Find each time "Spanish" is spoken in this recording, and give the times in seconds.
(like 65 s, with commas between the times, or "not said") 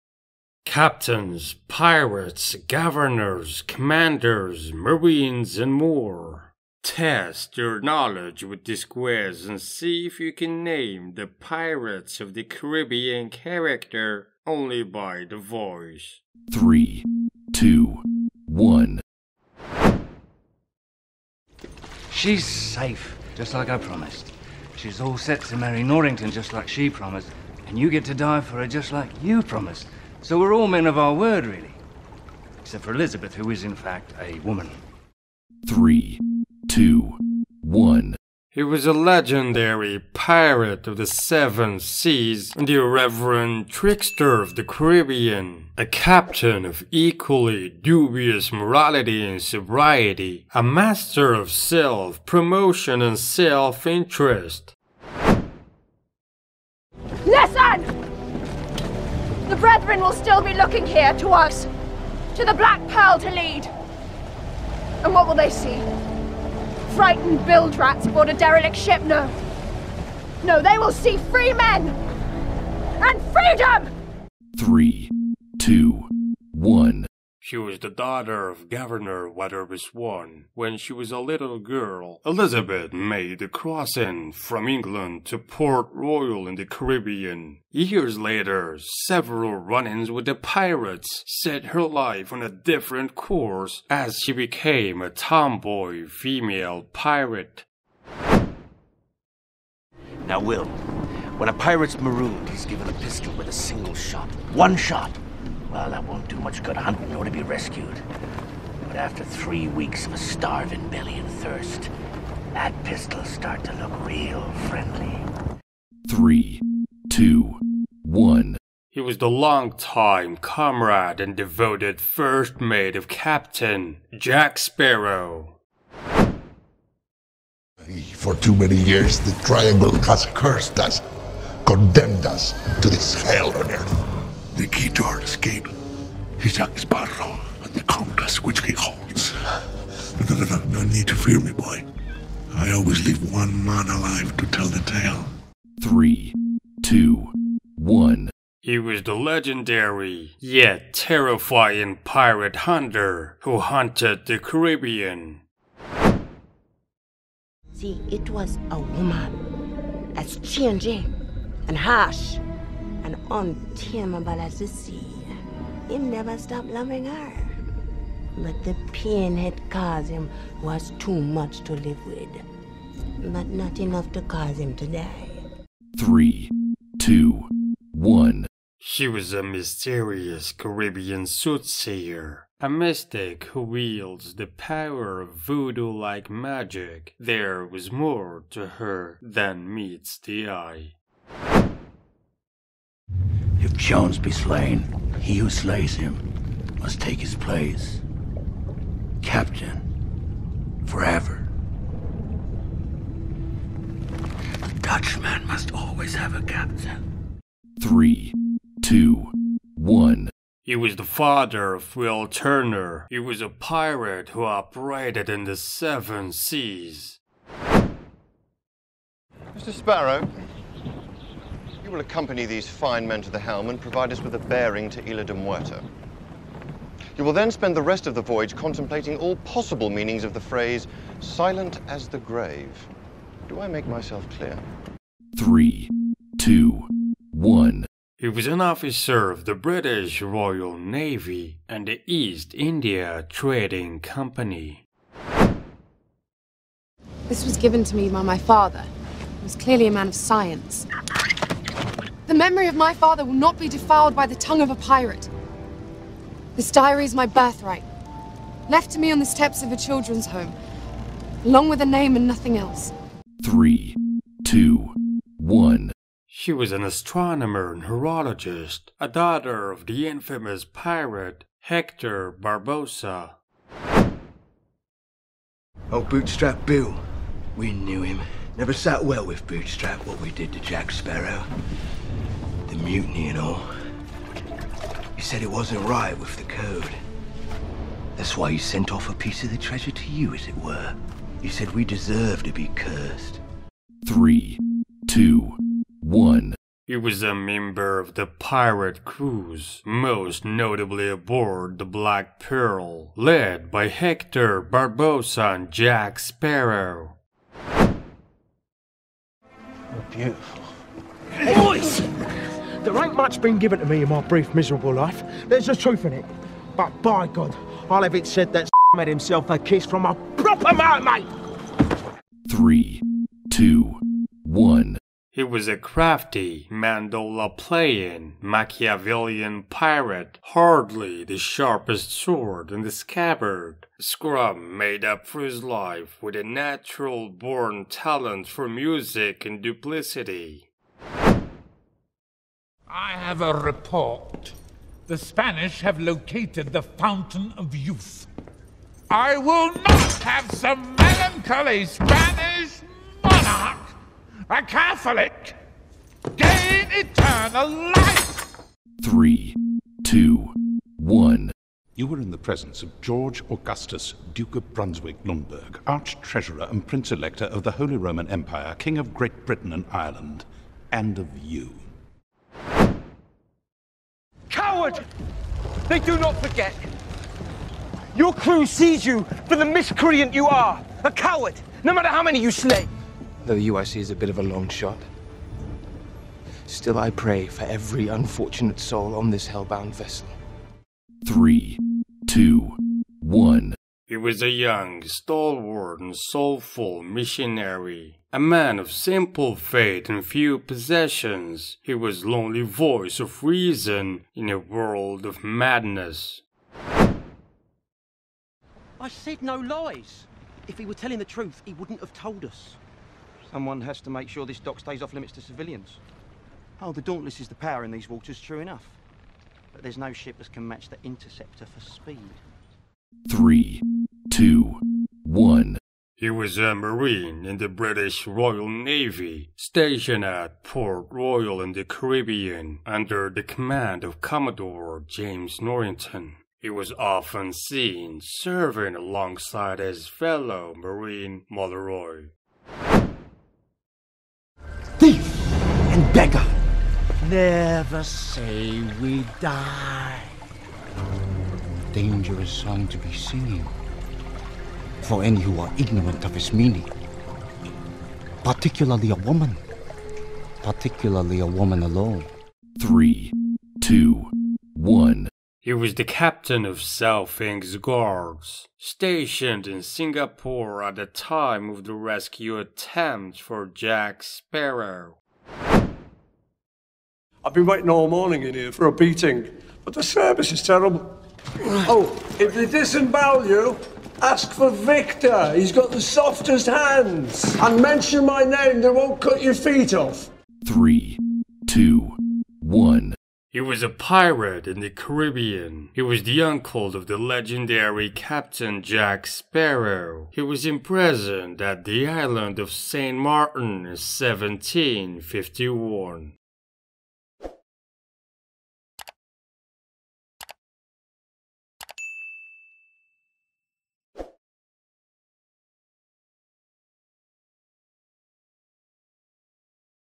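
345 s, 351 s.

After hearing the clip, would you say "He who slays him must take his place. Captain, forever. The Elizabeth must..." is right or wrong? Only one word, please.
wrong.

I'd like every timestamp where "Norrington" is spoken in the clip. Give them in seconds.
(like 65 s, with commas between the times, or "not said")
25 s, 435 s.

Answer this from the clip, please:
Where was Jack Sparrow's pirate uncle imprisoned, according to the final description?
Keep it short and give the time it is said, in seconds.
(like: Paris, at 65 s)
St. Martin, at 502 s.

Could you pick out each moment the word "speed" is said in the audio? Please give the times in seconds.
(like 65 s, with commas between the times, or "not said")
421 s.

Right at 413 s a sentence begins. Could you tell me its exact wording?
Someone has to make sure this dock stays off limits to civilians.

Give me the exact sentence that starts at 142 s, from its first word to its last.
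I always leave one man alive to tell the tale.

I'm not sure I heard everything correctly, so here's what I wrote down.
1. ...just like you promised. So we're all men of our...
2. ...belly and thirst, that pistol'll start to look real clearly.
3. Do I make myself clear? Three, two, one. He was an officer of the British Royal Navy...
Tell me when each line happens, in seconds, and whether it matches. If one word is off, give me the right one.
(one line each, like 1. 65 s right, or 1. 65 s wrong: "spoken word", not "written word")
1. 28 s right
2. 110 s wrong: "friendly", not "clearly"
3. 233 s right.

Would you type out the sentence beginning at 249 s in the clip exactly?
He was clearly a man of science.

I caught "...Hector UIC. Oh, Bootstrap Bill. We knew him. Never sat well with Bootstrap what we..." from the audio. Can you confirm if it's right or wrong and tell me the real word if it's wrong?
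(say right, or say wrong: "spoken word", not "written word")
wrong: "Barbossa", not "UIC".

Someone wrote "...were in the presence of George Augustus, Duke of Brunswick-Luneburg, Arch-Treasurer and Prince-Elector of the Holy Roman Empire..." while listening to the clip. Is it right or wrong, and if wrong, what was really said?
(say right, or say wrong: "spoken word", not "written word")
right.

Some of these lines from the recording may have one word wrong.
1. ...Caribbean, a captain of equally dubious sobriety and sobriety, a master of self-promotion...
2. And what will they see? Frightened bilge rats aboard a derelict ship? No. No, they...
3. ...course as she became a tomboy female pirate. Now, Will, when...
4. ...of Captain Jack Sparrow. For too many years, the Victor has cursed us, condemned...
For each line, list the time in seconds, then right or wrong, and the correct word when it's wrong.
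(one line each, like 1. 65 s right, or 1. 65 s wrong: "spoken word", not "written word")
1. 44 s wrong: "morality", not "sobriety"
2. 65 s right
3. 93 s right
4. 122 s wrong: "Triangle", not "Victor".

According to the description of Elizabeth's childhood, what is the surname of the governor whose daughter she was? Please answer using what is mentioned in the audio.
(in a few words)
Weatherby.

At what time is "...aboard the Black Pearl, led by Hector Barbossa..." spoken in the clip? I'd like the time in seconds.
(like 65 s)
301 s.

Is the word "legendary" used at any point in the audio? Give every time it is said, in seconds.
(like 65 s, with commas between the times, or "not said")
38 s, 149 s, 497 s.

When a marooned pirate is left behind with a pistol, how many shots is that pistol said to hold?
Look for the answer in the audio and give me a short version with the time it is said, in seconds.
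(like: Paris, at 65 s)
1, at 104 s.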